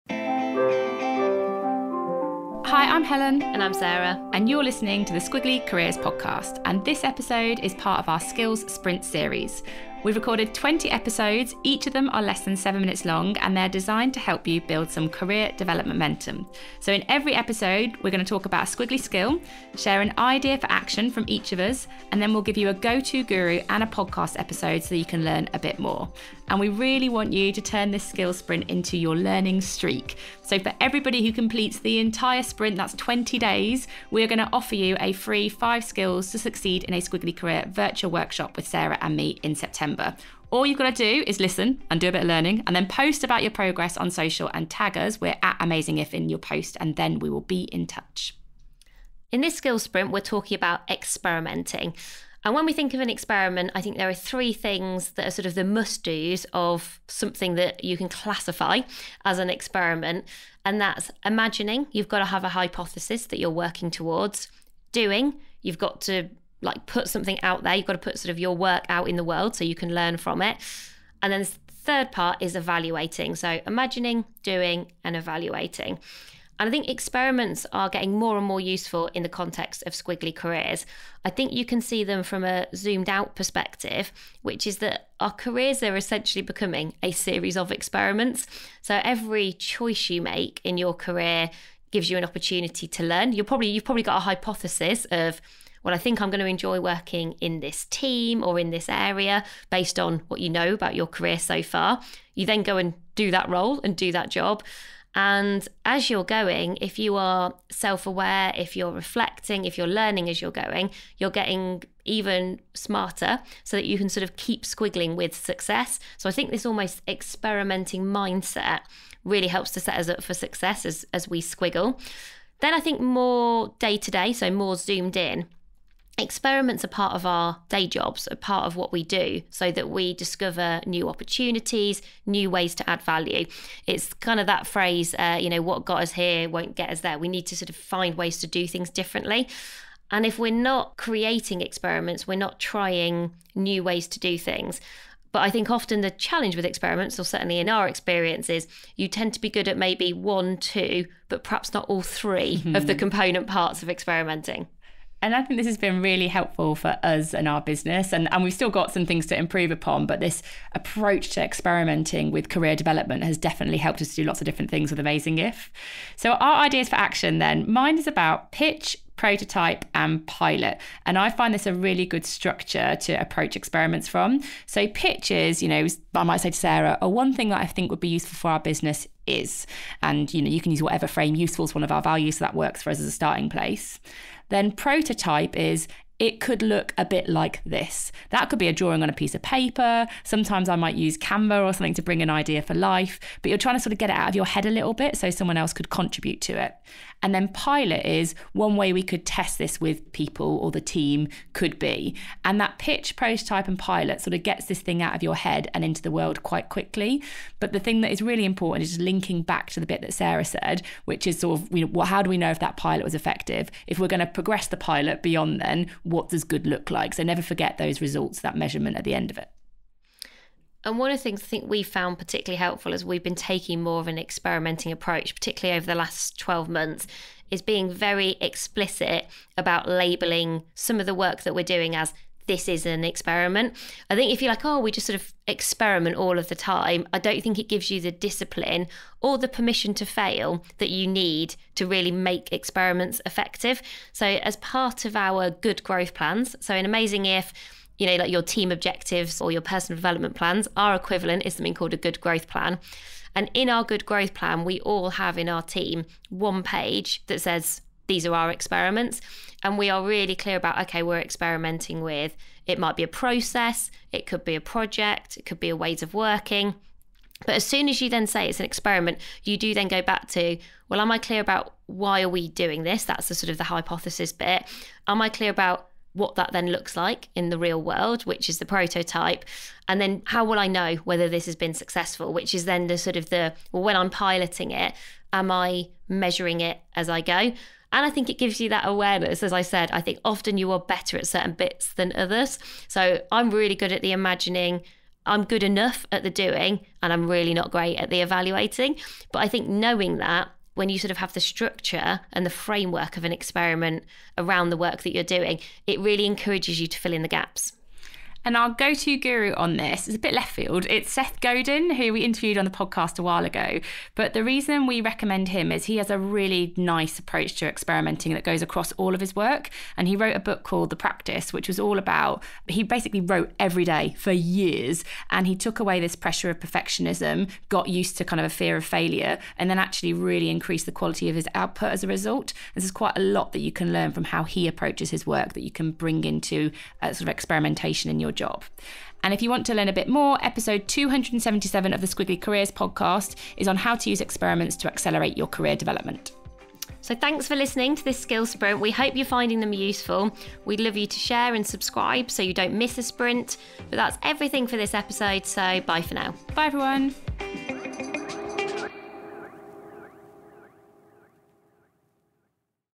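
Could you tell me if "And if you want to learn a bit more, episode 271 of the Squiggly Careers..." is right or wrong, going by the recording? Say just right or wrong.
wrong.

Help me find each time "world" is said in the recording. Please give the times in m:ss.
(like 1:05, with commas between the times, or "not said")
1:09, 3:26, 4:37.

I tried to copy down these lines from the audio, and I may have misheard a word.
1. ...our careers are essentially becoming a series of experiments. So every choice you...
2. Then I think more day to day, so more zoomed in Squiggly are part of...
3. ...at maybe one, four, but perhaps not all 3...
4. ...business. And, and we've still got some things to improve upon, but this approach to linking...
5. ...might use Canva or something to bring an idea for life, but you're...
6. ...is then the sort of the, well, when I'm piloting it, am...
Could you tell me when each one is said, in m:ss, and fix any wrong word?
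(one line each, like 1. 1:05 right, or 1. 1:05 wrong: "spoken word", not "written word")
1. 1:25 right
2. 2:02 wrong: "Experiments", not "Squiggly"
3. 2:29 wrong: "two", not "four"
4. 2:37 wrong: "experimenting", not "linking"
5. 3:10 right
6. 4:42 right.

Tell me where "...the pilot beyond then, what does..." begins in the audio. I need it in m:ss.
3:34.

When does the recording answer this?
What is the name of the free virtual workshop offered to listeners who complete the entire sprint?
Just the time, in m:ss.
0:35.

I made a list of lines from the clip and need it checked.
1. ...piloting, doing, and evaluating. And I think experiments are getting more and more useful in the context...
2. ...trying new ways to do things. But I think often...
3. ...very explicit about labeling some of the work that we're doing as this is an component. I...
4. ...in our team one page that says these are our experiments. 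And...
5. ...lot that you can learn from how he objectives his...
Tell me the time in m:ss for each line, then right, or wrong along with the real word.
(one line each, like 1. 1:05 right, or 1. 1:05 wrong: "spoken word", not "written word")
1. 1:13 wrong: "imagining", not "piloting"
2. 2:22 right
3. 3:47 wrong: "experiment", not "component"
4. 4:15 right
5. 5:33 wrong: "approaches", not "objectives".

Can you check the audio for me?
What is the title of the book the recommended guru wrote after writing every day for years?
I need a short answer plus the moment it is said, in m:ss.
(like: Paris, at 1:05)
The Practice, at 5:20.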